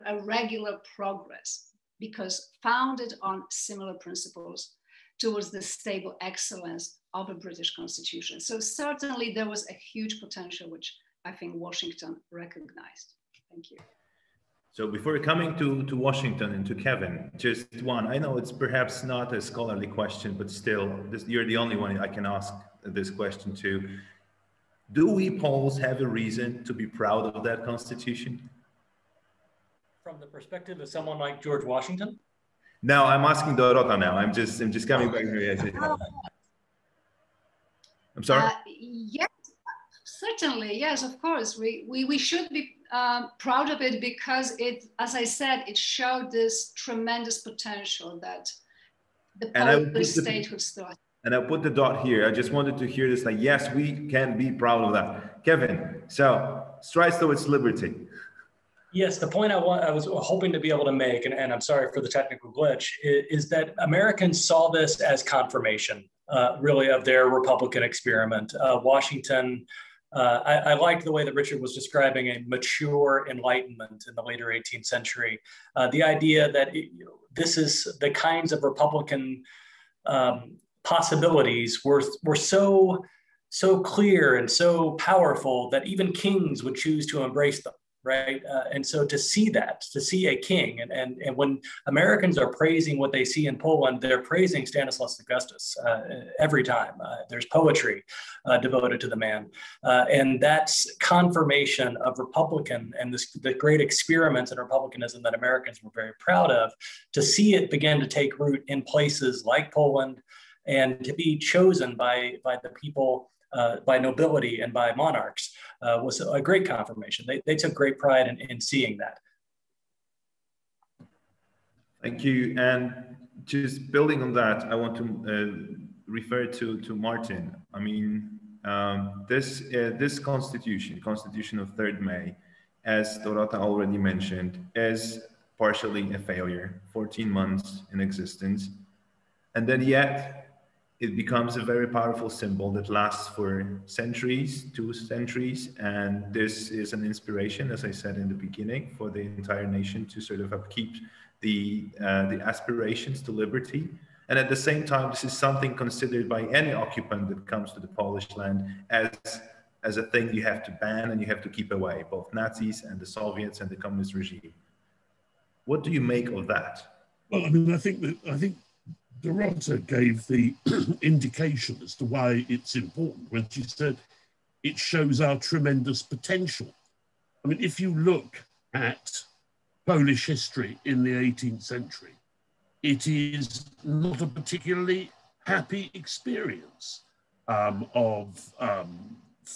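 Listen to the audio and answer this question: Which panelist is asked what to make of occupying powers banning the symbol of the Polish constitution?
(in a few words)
Martyn.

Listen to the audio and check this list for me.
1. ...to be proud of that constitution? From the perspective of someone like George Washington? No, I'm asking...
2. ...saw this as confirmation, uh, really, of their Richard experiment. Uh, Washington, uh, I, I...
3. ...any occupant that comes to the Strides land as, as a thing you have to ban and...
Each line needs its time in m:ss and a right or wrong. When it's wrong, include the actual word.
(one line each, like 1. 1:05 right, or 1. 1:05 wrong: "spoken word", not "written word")
1. 0:26 right
2. 1:04 wrong: "Republican", not "Richard"
3. 2:36 wrong: "Polish", not "Strides".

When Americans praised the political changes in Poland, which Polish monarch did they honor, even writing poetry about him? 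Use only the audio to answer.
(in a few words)
Stanislaus Augustus.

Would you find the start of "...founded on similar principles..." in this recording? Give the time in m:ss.
0:02.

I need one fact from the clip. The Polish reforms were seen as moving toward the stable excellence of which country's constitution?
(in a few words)
British.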